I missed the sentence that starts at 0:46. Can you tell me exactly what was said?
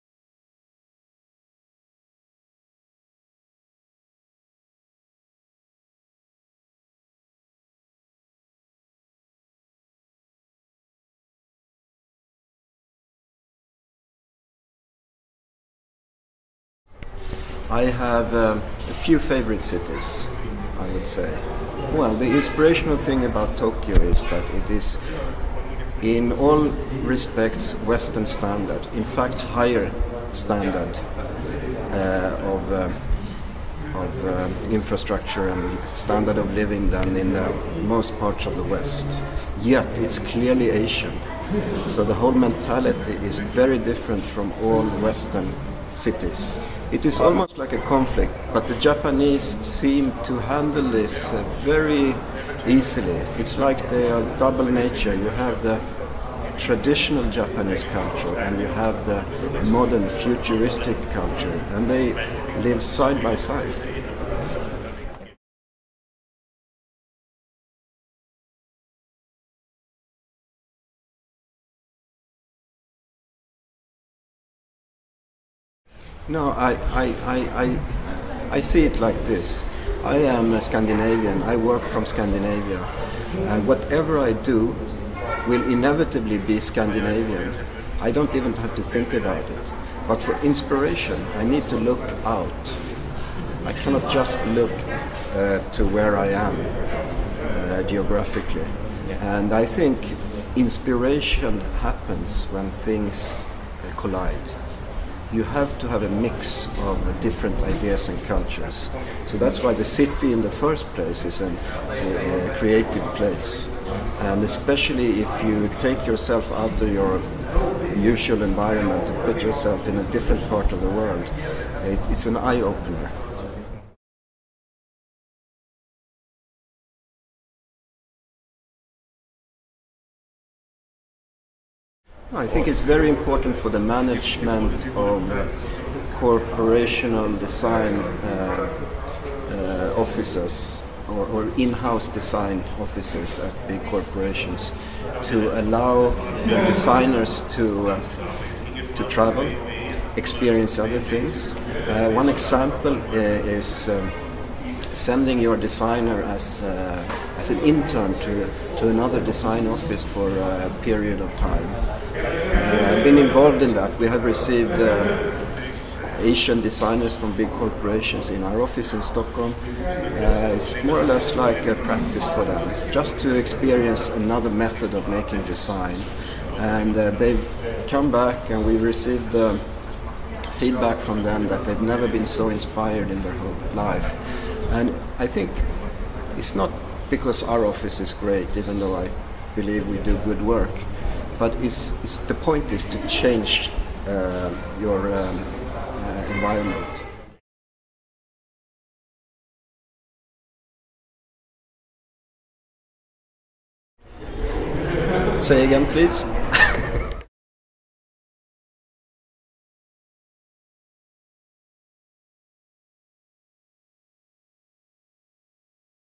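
It is almost like a conflict, but the Japanese seem to handle this uh, very easily.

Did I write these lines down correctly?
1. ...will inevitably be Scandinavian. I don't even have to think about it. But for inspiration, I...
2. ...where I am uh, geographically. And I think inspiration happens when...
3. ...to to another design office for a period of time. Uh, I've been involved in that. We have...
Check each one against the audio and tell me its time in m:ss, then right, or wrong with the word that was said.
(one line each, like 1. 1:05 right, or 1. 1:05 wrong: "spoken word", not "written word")
1. 1:25 right
2. 1:35 right
3. 2:38 right.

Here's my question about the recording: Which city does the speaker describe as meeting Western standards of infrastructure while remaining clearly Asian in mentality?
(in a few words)
Tokyo.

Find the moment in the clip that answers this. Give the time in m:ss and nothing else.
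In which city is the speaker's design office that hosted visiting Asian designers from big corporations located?
2:49.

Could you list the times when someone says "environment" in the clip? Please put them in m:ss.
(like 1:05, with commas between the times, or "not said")
1:58, 3:16.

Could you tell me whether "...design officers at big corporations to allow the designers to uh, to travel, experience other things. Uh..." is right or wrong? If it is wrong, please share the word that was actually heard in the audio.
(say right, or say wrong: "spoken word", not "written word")
right.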